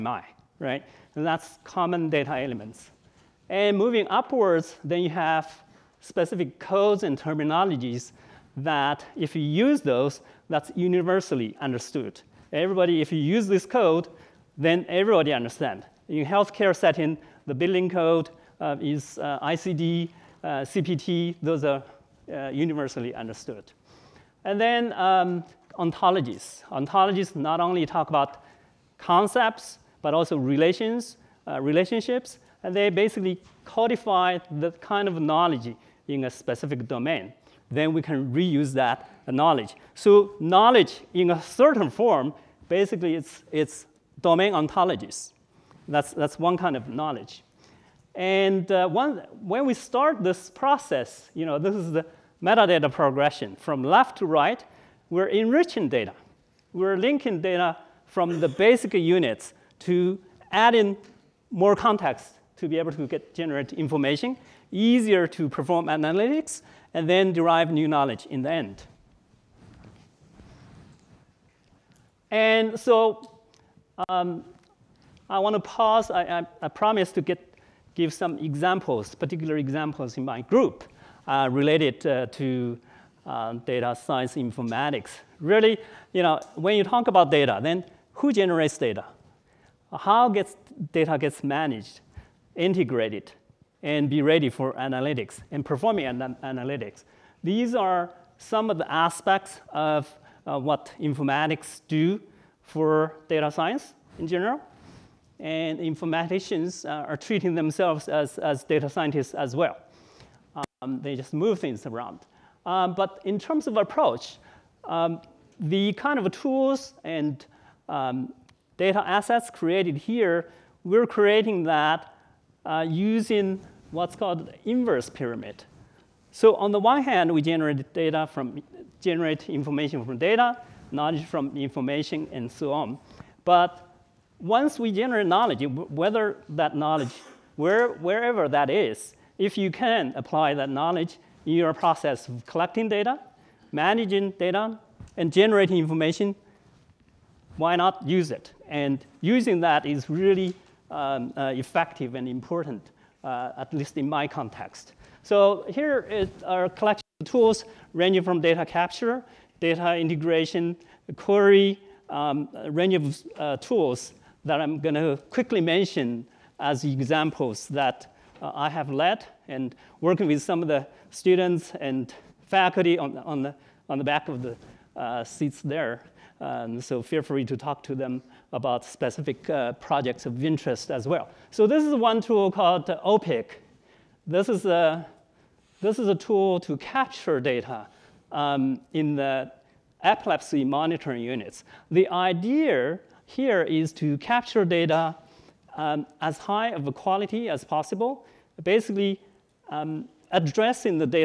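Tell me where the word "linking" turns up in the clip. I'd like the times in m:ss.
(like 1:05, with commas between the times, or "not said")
0:56.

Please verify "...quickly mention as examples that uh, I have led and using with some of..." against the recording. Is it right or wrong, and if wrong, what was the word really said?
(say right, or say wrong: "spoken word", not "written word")
wrong: "working", not "using".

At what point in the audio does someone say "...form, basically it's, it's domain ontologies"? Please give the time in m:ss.
0:41.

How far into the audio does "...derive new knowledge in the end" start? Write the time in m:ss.
1:07.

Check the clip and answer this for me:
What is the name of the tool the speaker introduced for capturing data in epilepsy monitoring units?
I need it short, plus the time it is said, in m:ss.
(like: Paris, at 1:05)
OPIC, at 3:02.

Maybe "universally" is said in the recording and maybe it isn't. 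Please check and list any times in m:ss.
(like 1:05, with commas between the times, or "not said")
0:10, 0:22.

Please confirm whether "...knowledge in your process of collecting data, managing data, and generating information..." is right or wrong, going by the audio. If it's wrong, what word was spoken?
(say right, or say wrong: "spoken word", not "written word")
right.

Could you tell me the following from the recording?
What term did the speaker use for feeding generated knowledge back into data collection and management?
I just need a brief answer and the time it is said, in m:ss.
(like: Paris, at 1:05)
inverse pyramid, at 2:04.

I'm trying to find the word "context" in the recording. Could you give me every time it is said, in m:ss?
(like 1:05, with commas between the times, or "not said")
1:01, 2:34.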